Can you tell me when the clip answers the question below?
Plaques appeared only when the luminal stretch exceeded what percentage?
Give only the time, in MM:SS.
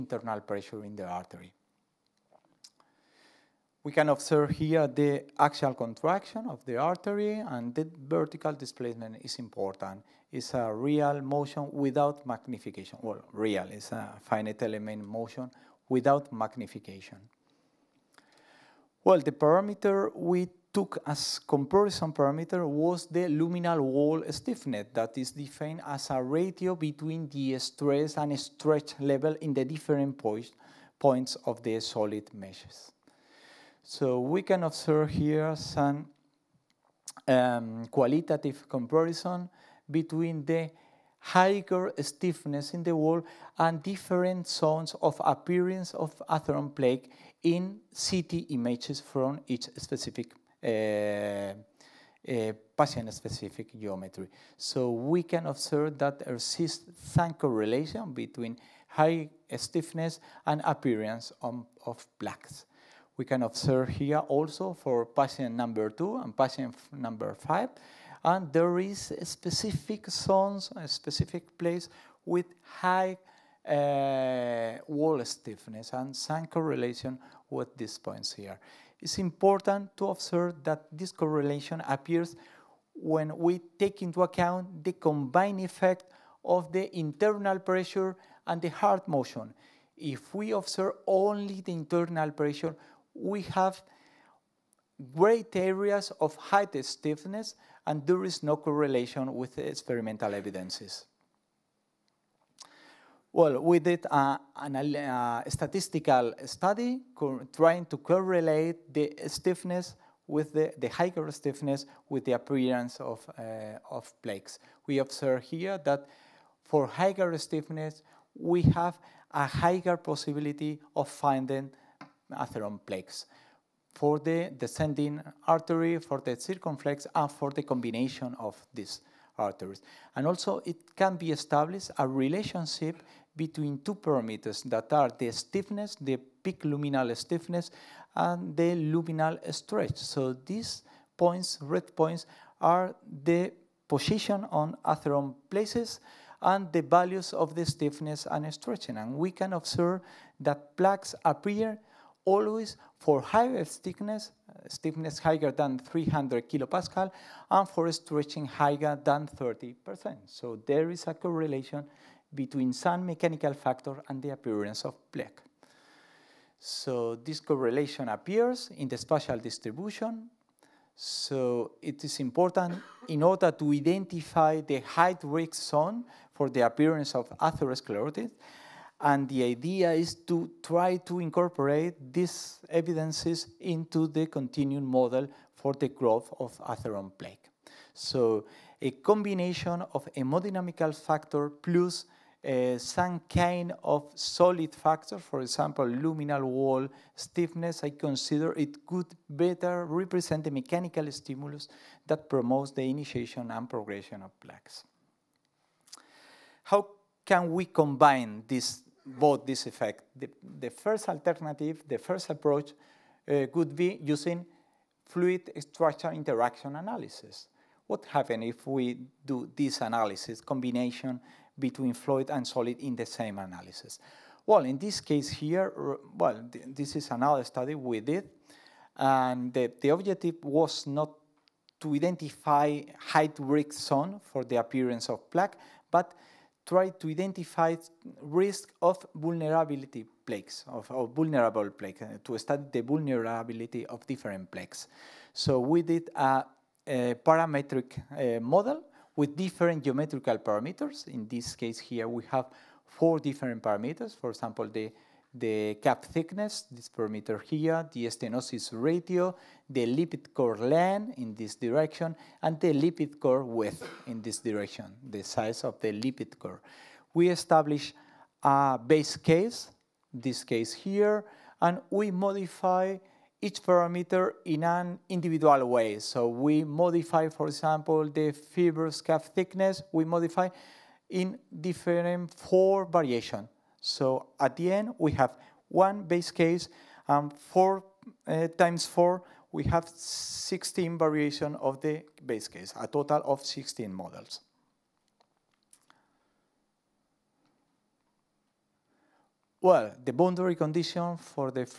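02:39.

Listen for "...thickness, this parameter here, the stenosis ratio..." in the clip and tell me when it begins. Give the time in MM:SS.
04:16.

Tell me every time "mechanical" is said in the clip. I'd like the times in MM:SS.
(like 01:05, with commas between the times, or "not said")
02:43, 03:20.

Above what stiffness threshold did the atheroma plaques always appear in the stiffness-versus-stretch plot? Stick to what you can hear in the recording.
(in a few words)
300 kilopascal.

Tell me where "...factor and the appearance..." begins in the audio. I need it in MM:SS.
02:43.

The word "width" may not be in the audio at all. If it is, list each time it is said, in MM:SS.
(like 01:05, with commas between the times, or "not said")
04:23.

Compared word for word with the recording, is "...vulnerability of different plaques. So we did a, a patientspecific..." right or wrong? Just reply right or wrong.
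wrong.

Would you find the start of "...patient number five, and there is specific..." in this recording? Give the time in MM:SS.
01:06.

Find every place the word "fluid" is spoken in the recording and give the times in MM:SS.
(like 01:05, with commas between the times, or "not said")
03:35, 03:41.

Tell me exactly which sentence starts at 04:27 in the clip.
We establish a base case, this case here, and we modify each parameter in an individual way.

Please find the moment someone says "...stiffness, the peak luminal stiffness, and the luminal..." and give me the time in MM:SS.
02:15.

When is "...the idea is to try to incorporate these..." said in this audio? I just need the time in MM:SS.
02:59.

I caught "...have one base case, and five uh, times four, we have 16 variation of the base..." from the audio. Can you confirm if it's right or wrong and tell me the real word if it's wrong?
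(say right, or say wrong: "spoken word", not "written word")
wrong: "four", not "five".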